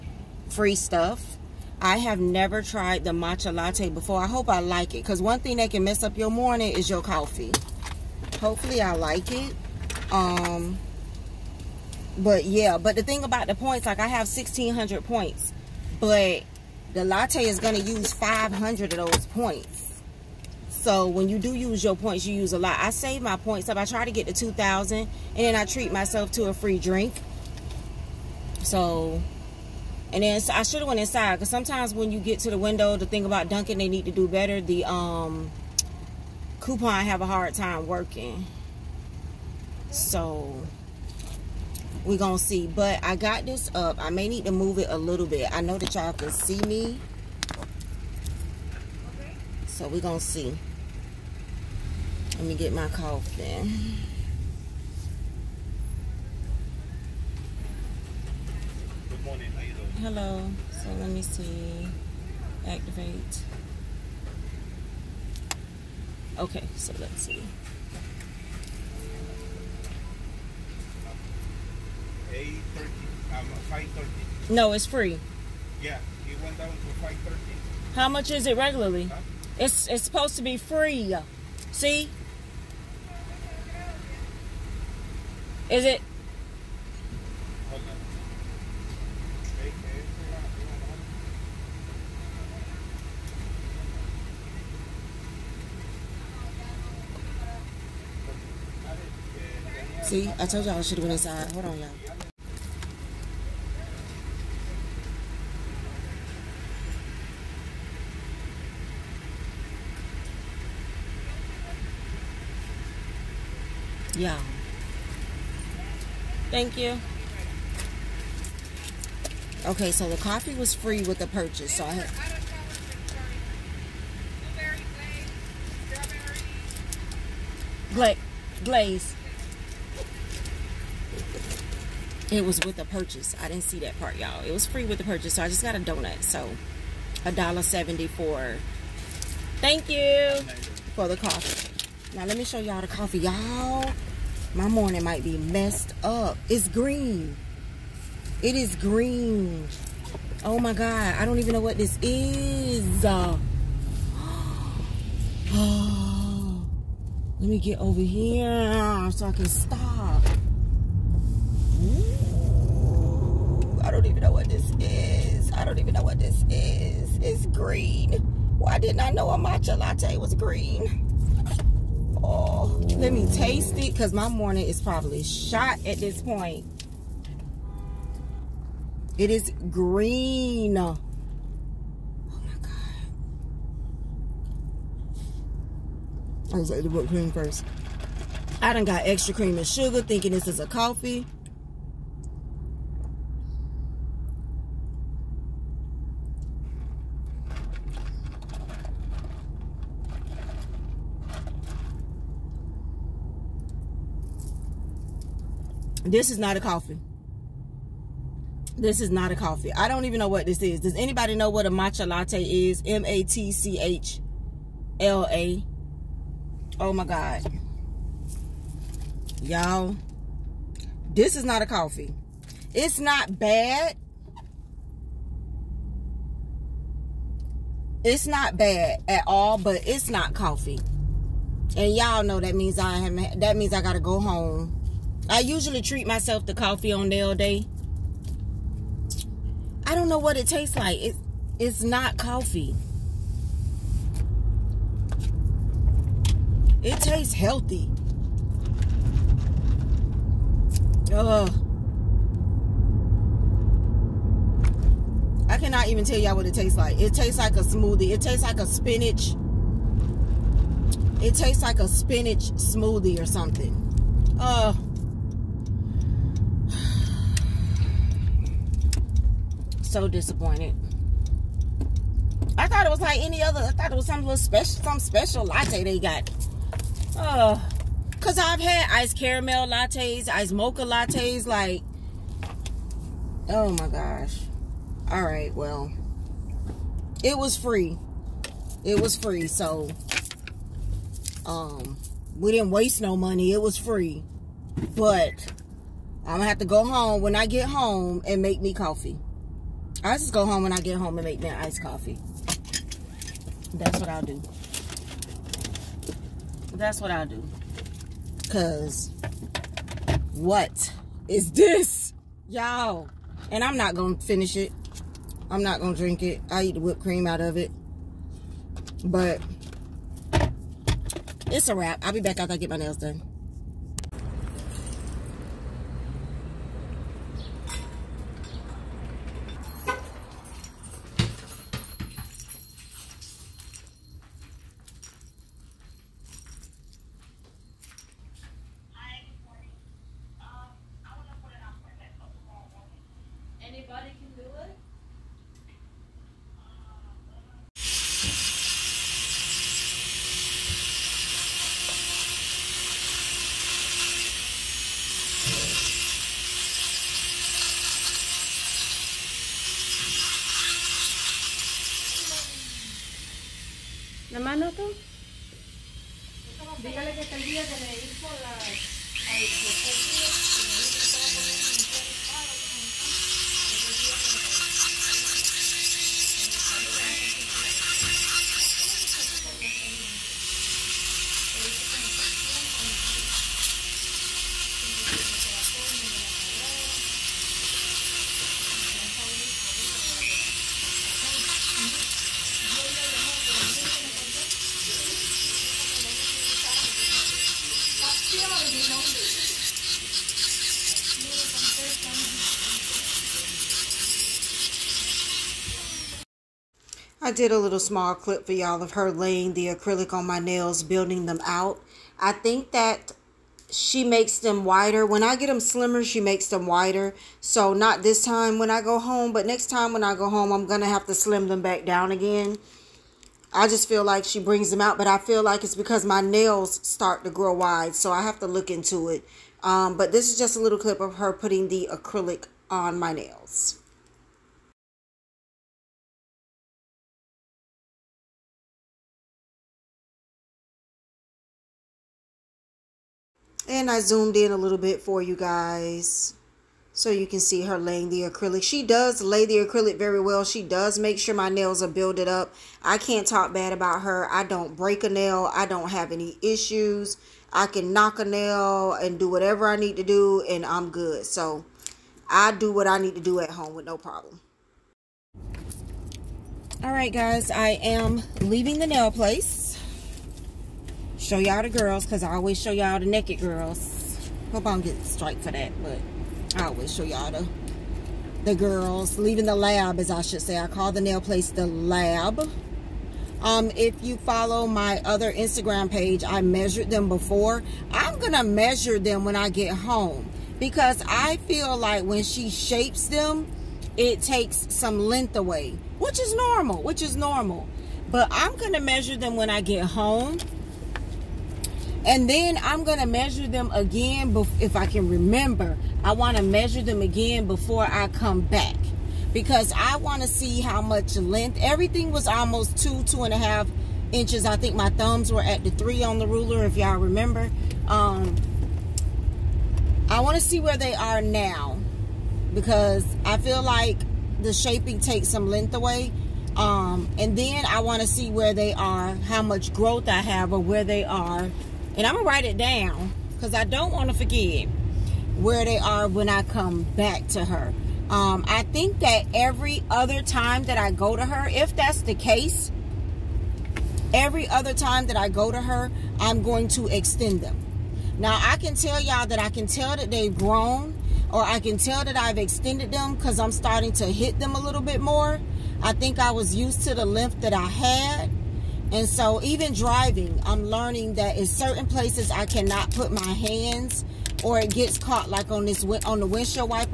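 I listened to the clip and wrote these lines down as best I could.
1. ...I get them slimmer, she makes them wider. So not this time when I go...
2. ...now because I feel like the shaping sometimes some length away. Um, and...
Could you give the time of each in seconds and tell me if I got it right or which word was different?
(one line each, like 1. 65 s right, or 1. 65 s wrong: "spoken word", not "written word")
1. 415 s right
2. 521 s wrong: "takes", not "sometimes".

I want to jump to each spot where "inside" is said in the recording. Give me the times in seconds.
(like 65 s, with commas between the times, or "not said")
31 s, 101 s.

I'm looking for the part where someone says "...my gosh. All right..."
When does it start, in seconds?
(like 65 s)
283 s.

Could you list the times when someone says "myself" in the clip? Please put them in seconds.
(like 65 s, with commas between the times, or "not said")
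25 s, 236 s.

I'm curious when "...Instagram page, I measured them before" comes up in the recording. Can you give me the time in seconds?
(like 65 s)
485 s.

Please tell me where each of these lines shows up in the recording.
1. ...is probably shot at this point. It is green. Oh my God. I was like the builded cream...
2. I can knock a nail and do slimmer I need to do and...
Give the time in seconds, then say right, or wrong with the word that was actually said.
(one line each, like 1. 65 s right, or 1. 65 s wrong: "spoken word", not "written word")
1. 174 s wrong: "whipped", not "builded"
2. 457 s wrong: "whatever", not "slimmer".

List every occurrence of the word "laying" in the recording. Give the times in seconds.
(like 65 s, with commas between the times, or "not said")
409 s, 447 s.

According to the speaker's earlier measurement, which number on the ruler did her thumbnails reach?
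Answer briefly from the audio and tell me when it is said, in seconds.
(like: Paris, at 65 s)
3, at 515 s.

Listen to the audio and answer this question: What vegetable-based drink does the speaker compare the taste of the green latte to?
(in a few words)
spinach smoothie.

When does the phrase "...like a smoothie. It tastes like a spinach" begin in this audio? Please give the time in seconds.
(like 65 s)
257 s.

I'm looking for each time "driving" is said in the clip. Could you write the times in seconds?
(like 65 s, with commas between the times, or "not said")
559 s.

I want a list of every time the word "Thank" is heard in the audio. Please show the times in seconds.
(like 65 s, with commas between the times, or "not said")
116 s, 139 s.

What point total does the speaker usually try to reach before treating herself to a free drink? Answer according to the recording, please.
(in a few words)
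2,000.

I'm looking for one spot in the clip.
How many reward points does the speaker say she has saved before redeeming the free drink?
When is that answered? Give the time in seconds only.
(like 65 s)
14 s.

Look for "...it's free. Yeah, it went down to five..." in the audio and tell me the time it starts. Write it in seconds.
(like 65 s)
74 s.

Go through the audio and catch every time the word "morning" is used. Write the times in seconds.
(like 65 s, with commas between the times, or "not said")
6 s, 59 s, 144 s, 174 s.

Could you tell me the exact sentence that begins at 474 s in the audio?
Hope I don't get strike for that, but I always show y'all the, the girls.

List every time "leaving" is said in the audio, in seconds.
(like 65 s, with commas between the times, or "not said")
468 s, 479 s.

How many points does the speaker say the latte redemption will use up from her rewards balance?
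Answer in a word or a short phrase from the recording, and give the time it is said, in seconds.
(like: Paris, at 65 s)
500, at 18 s.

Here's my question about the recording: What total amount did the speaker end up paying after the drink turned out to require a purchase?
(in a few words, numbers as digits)
$1.70.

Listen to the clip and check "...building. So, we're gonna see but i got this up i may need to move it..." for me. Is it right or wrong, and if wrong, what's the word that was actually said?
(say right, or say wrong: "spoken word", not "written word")
wrong: "working", not "building".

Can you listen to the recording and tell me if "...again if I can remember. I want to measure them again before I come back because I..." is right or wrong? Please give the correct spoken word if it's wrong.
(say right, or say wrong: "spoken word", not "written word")
right.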